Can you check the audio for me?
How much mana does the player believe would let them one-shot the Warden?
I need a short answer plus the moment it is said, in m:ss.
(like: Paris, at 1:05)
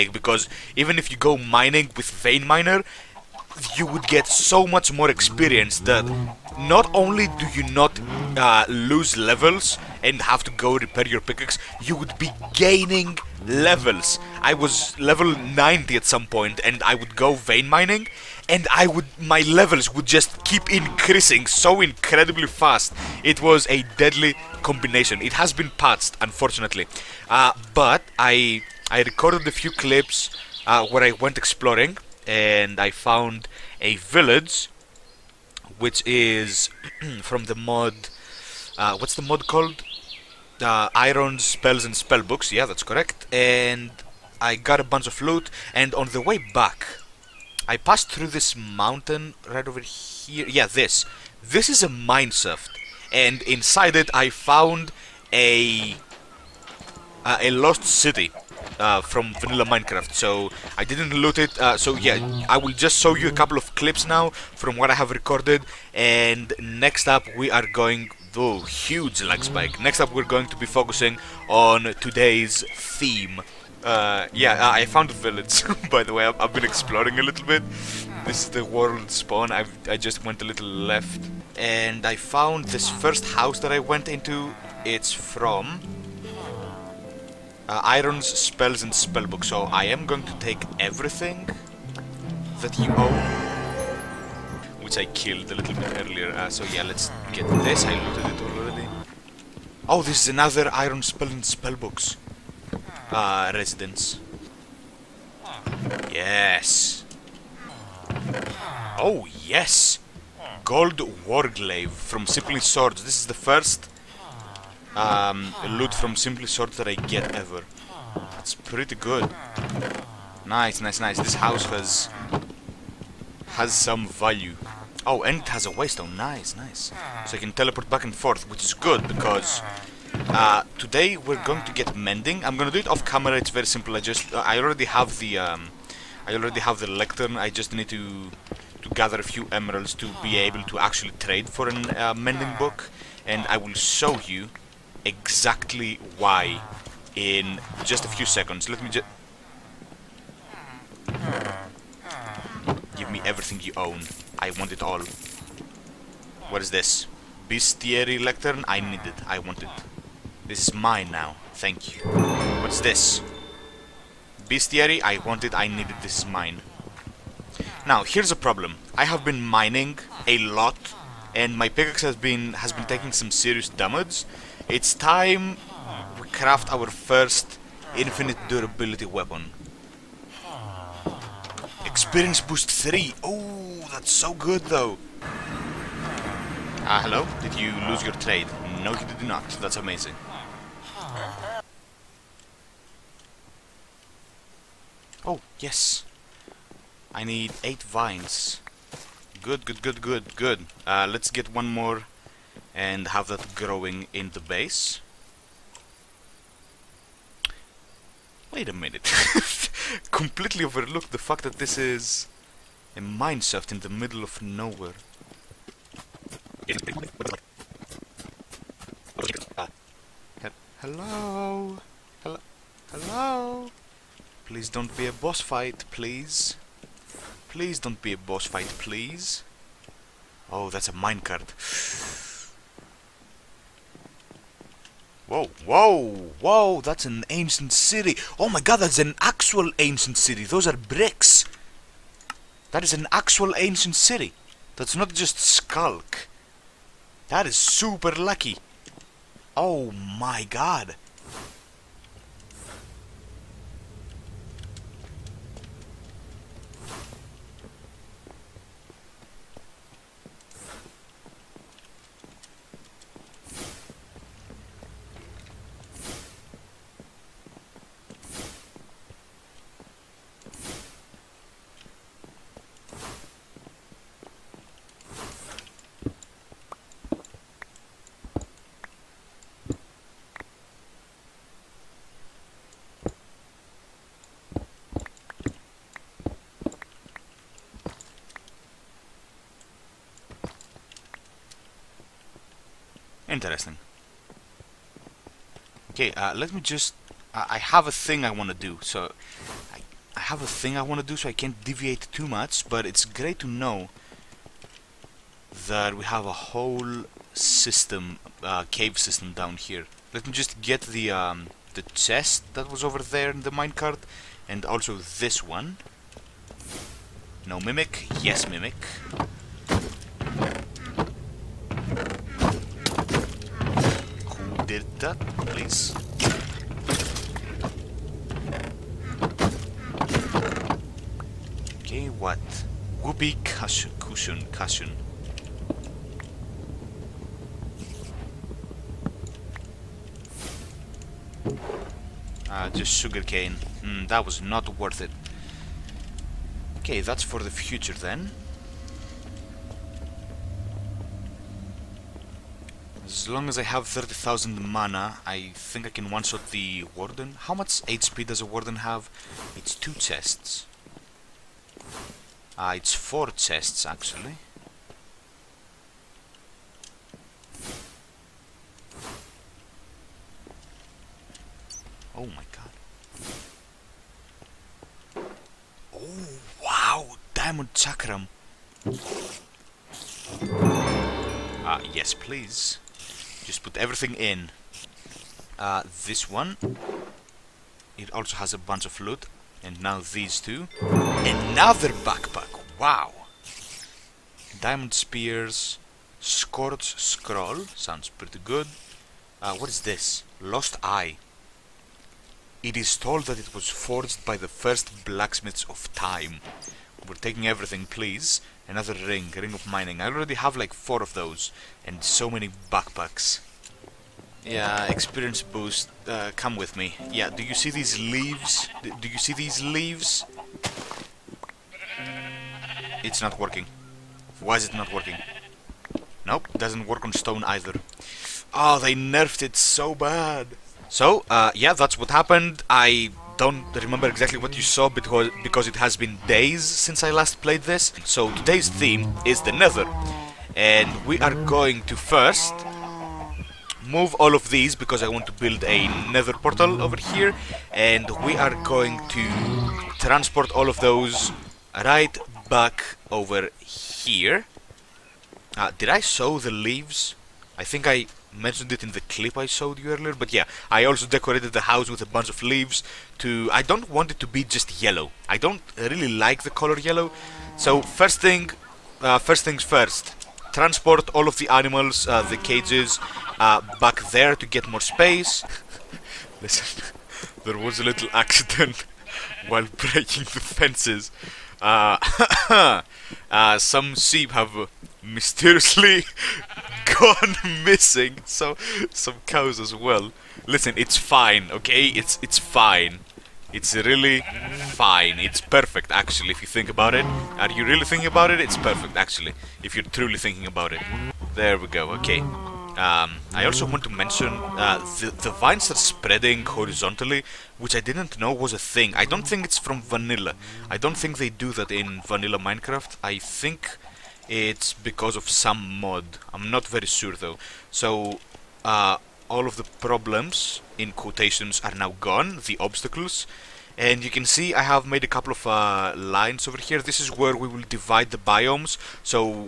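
30,000, at 5:53.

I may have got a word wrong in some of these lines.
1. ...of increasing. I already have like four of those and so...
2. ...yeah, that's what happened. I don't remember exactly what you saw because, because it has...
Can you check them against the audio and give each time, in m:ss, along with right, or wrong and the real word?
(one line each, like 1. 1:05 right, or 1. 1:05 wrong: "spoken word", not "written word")
1. 6:49 wrong: "mining", not "increasing"
2. 7:11 right.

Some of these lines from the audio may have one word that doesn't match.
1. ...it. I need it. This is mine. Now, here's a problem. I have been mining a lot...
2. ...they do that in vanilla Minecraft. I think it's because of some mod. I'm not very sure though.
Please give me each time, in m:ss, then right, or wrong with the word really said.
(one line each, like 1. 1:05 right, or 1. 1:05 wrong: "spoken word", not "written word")
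1. 2:45 right
2. 8:31 right.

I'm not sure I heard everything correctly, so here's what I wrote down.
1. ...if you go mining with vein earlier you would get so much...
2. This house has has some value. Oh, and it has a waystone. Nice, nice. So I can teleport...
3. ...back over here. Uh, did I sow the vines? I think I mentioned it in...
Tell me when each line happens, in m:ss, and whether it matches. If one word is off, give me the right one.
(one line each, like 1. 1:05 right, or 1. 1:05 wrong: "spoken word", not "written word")
1. 0:00 wrong: "miner", not "earlier"
2. 2:01 right
3. 7:32 wrong: "leaves", not "vines".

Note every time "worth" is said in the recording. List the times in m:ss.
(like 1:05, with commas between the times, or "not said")
5:44.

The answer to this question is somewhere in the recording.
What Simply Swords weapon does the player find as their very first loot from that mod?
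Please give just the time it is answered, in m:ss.
1:50.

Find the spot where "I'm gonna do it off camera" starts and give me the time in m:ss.
2:12.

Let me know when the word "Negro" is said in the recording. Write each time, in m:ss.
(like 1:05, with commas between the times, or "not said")
not said.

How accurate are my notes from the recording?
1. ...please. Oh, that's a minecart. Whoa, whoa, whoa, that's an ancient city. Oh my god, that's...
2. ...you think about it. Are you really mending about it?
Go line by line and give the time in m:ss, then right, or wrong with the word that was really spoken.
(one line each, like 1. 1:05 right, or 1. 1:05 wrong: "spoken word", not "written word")
1. 3:48 right
2. 8:16 wrong: "thinking", not "mending".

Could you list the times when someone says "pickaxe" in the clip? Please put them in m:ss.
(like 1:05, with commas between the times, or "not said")
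0:11, 2:51.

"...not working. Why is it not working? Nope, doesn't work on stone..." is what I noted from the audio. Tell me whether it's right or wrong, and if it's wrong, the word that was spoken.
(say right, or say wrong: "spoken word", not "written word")
right.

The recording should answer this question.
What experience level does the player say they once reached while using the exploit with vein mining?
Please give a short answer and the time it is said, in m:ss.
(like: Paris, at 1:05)
90, at 0:14.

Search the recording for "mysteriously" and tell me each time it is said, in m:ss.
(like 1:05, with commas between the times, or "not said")
8:05.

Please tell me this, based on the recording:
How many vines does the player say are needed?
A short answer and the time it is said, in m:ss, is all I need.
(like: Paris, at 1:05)
8, at 3:17.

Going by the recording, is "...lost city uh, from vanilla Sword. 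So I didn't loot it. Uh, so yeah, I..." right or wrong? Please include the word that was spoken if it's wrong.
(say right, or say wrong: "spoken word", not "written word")
wrong: "Minecraft", not "Sword".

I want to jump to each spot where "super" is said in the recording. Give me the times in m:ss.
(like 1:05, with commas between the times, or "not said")
4:07.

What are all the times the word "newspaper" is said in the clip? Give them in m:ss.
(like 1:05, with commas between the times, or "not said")
not said.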